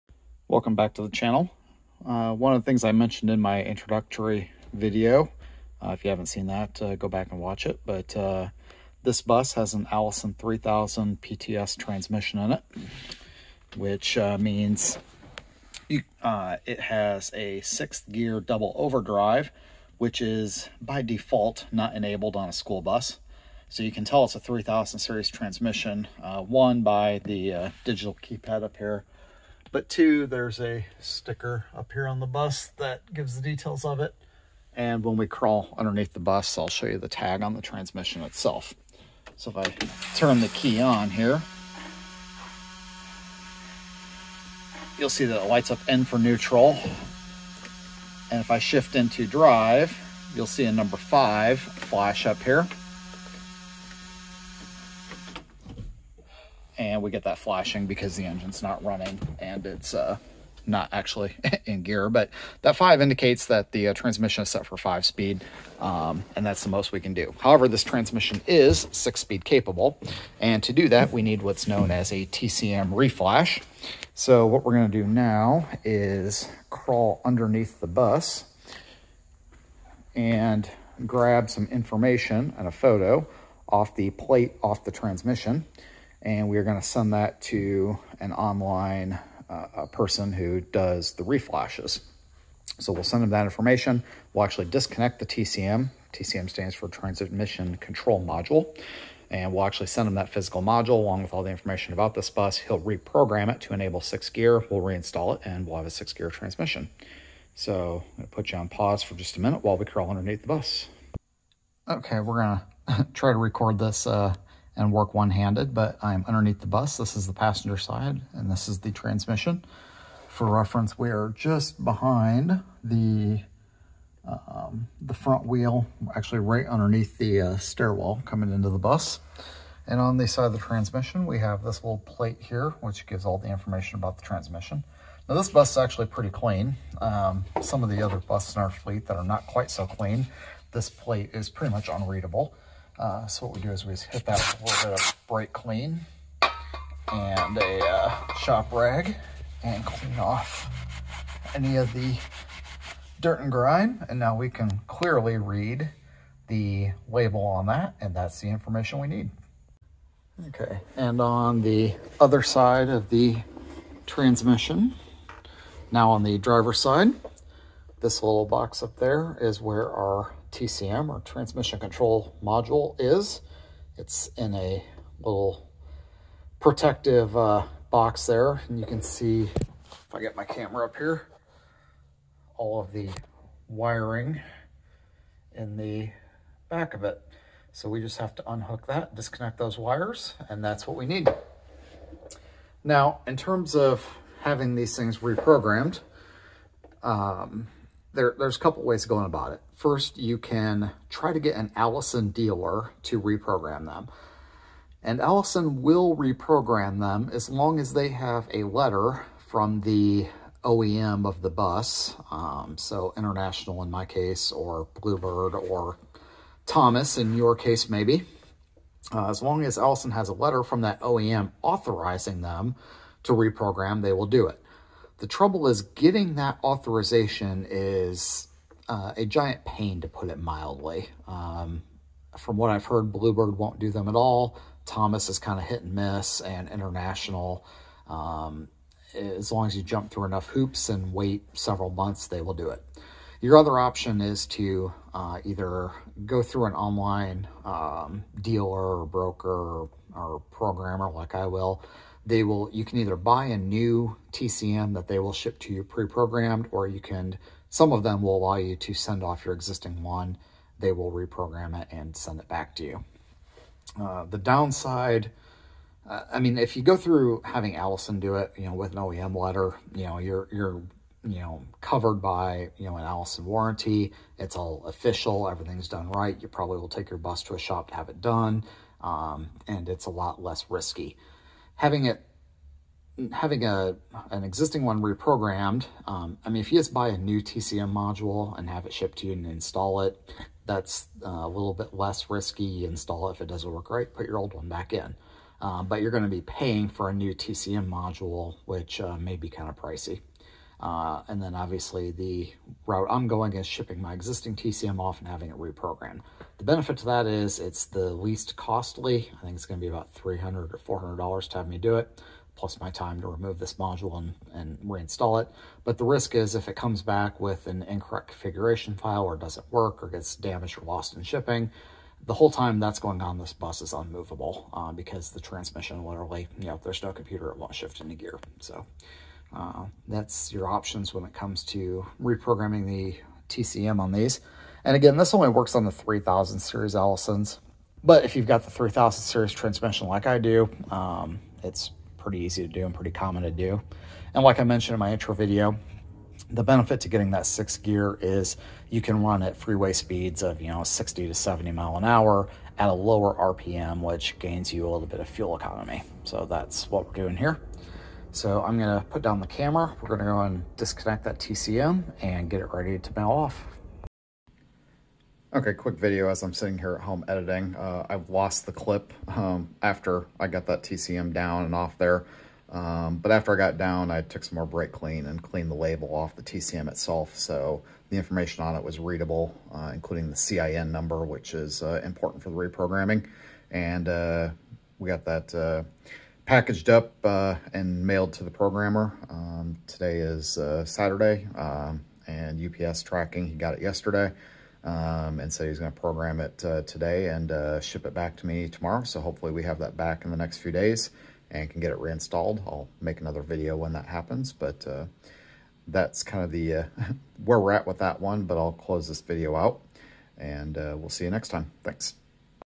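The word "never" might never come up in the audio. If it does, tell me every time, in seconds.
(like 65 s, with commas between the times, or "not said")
not said.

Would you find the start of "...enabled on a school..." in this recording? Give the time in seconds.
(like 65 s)
21 s.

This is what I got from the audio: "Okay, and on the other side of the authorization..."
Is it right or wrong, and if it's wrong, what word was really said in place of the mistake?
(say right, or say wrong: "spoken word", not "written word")
wrong: "transmission", not "authorization".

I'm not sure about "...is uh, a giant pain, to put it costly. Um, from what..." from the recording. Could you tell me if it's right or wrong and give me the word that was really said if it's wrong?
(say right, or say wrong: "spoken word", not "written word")
wrong: "mildly", not "costly".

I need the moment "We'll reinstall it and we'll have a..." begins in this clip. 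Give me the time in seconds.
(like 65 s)
104 s.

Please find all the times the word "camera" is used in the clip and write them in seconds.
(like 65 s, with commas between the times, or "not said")
180 s, 359 s.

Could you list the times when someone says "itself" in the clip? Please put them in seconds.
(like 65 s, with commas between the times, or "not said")
38 s, 376 s.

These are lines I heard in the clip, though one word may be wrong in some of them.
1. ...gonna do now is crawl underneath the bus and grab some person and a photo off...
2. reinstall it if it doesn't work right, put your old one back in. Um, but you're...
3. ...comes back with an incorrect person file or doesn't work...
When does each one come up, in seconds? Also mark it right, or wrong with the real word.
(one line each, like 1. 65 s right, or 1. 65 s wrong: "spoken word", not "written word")
1. 74 s wrong: "information", not "person"
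2. 292 s wrong: "install", not "reinstall"
3. 316 s wrong: "configuration", not "person".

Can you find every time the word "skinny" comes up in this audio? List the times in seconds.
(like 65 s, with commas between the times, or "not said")
not said.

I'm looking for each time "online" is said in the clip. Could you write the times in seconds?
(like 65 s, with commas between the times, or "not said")
88 s, 246 s.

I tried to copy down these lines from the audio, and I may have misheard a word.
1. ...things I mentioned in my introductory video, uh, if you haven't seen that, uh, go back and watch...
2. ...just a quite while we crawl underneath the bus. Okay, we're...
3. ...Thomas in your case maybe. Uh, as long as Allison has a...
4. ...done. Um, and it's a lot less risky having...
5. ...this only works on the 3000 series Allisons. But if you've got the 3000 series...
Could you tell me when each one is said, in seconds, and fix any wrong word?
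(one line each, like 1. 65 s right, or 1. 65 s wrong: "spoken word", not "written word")
1. 2 s right
2. 109 s wrong: "minute", not "quite"
3. 216 s right
4. 278 s right
5. 335 s right.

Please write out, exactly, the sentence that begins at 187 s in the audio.
So we just have to unhook that, disconnect those wires, and that's what we need.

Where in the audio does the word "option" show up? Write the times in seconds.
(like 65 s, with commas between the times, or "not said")
243 s, 330 s.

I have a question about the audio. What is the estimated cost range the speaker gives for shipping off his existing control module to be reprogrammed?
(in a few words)
$300 to $400.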